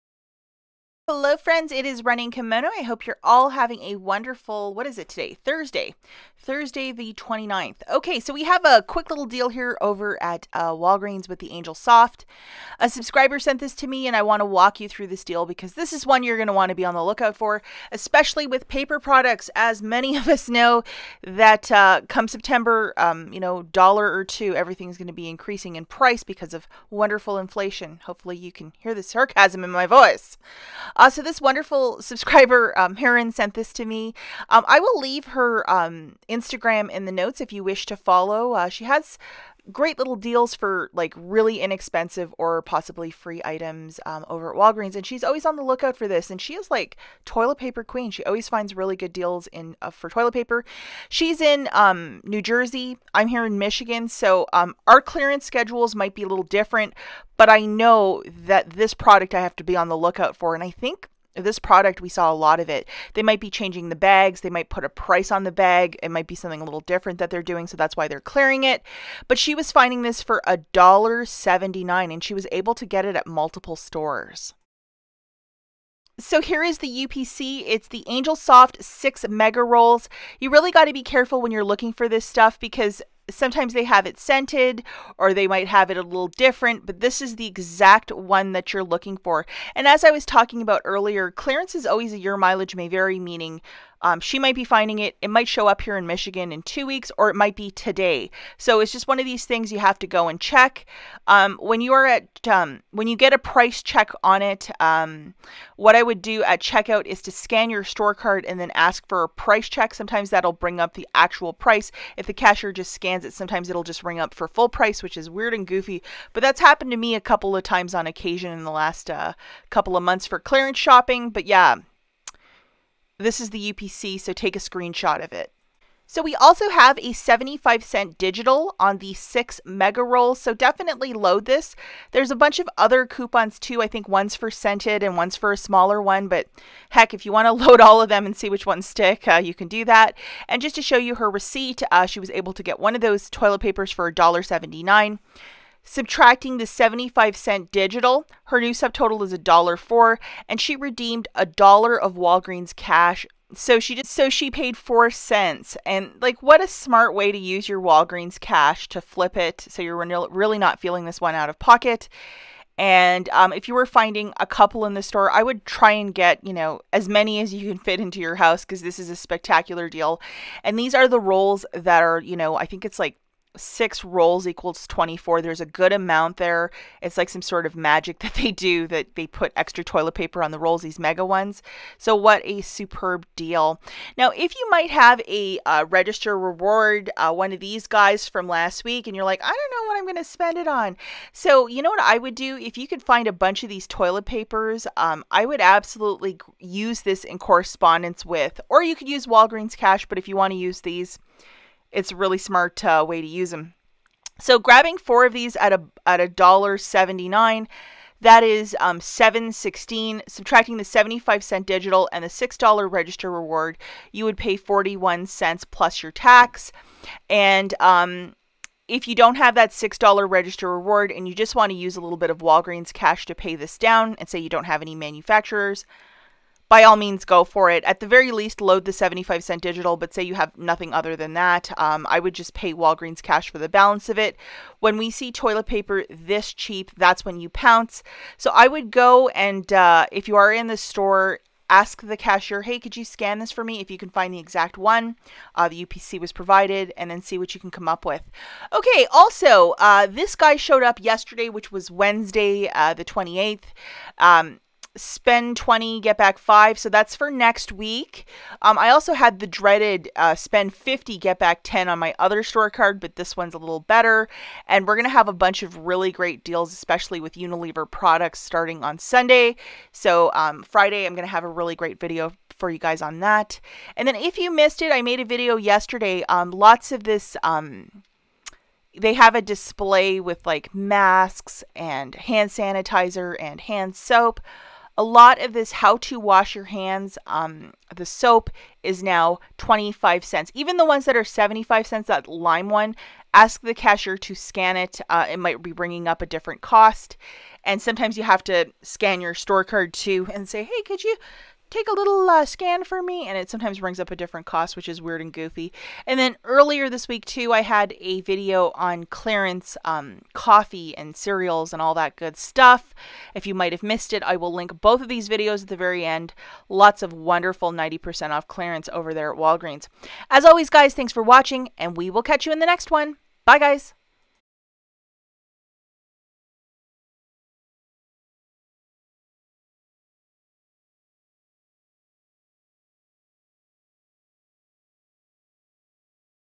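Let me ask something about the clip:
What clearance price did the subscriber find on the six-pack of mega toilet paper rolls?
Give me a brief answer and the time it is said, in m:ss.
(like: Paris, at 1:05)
$1.79, at 1:10.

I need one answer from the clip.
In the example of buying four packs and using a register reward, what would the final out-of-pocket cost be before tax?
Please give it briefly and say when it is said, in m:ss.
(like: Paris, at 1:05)
41 cents, at 3:34.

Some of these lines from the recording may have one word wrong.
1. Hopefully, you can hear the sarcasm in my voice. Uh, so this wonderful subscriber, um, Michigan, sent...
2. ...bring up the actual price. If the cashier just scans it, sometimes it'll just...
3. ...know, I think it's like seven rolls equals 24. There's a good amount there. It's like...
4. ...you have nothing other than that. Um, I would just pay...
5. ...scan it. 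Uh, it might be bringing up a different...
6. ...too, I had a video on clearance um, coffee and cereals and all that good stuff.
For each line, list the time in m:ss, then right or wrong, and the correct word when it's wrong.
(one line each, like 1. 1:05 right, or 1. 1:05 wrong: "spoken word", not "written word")
1. 0:28 wrong: "Heron", not "Michigan"
2. 1:50 right
3. 2:52 wrong: "six", not "seven"
4. 3:50 right
5. 4:54 right
6. 5:07 right.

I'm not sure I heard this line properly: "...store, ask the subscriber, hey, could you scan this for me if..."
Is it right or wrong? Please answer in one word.
wrong.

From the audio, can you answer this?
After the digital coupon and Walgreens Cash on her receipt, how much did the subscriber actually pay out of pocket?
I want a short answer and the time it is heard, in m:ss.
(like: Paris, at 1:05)
4 cents, at 2:34.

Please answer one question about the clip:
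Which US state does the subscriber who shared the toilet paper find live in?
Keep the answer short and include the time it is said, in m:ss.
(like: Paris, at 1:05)
New Jersey, at 0:52.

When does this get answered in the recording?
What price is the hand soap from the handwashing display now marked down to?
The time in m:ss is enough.
4:49.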